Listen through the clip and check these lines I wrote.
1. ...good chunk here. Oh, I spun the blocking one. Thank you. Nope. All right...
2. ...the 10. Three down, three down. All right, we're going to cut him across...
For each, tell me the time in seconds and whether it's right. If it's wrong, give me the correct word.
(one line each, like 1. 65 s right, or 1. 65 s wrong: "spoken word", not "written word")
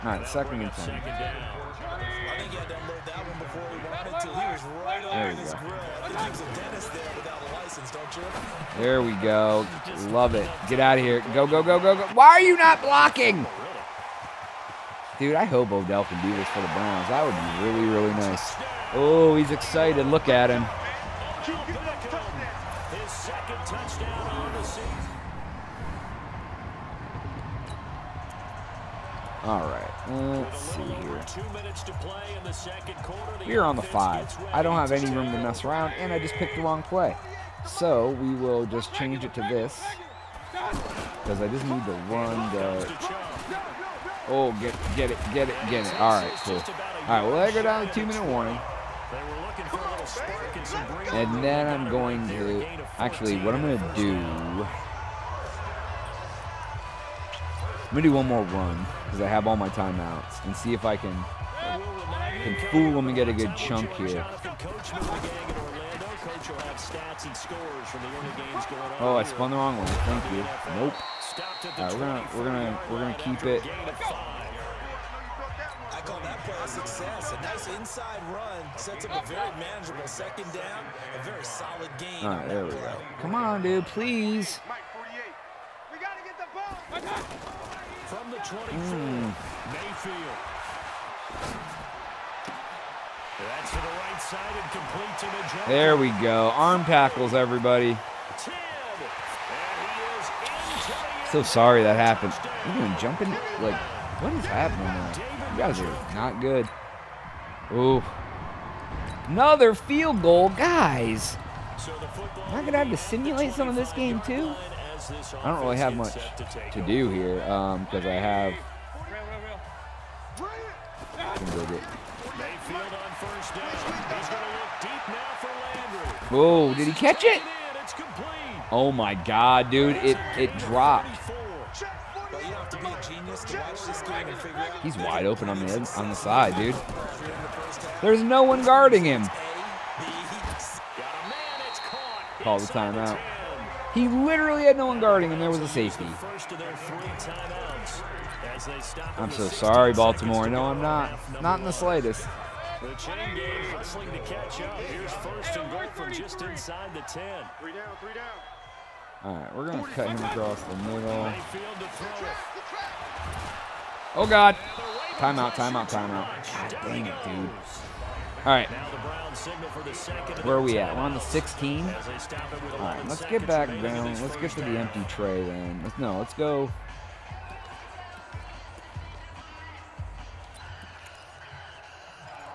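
1. 63 s wrong: "wrong", not "blocking"
2. 156 s right.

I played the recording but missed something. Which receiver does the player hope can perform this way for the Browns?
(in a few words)
Odell.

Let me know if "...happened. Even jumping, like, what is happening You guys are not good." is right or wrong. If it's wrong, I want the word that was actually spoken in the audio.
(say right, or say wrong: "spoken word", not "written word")
right.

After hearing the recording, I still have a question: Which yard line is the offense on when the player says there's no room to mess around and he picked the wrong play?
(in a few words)
5.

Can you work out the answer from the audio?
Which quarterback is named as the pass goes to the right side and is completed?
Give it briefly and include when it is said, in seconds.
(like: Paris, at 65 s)
Mayfield, at 89 s.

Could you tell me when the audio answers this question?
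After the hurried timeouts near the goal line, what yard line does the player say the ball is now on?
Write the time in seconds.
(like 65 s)
171 s.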